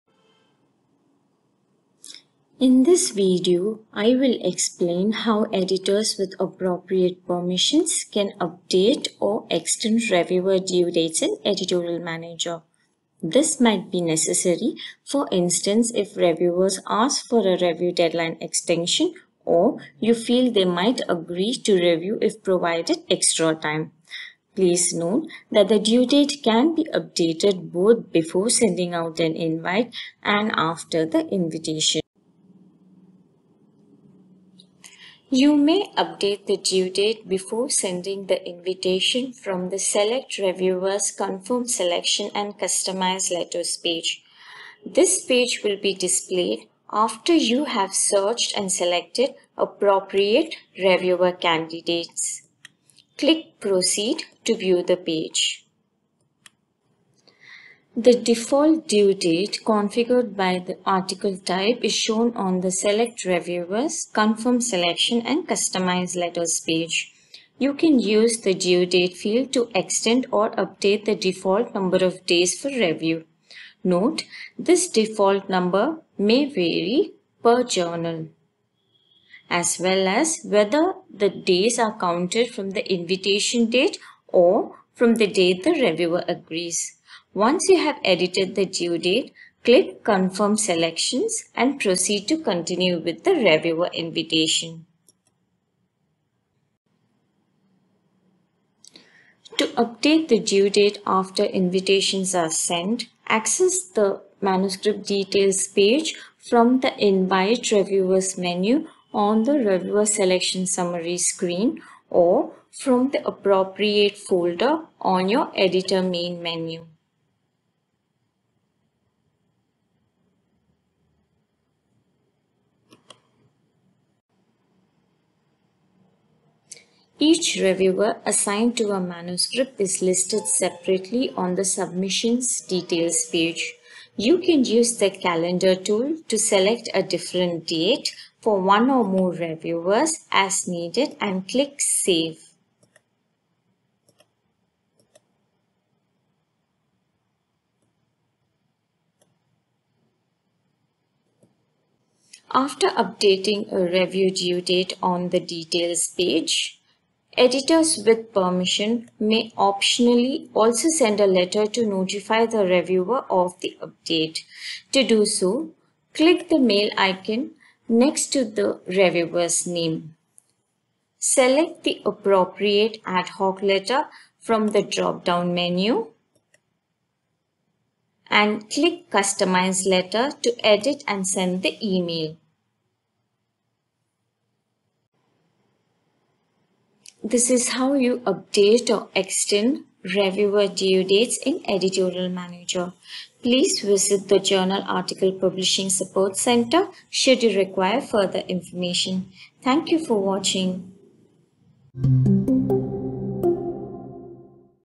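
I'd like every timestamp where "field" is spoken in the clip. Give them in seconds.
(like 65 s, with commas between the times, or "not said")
69 s.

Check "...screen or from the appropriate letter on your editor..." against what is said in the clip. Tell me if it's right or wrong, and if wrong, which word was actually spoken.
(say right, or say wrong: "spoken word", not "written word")
wrong: "folder", not "letter".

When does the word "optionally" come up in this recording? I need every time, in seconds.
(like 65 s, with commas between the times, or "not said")
159 s.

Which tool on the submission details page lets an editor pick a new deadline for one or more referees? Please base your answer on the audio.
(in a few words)
calendar tool.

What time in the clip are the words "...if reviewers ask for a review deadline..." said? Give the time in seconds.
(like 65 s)
15 s.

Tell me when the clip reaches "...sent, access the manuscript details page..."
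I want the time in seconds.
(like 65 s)
102 s.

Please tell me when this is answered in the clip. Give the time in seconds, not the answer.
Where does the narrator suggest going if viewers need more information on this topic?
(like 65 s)
194 s.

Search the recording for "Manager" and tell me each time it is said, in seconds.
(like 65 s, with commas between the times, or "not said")
11 s, 192 s.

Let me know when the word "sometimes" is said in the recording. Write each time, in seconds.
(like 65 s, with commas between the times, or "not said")
not said.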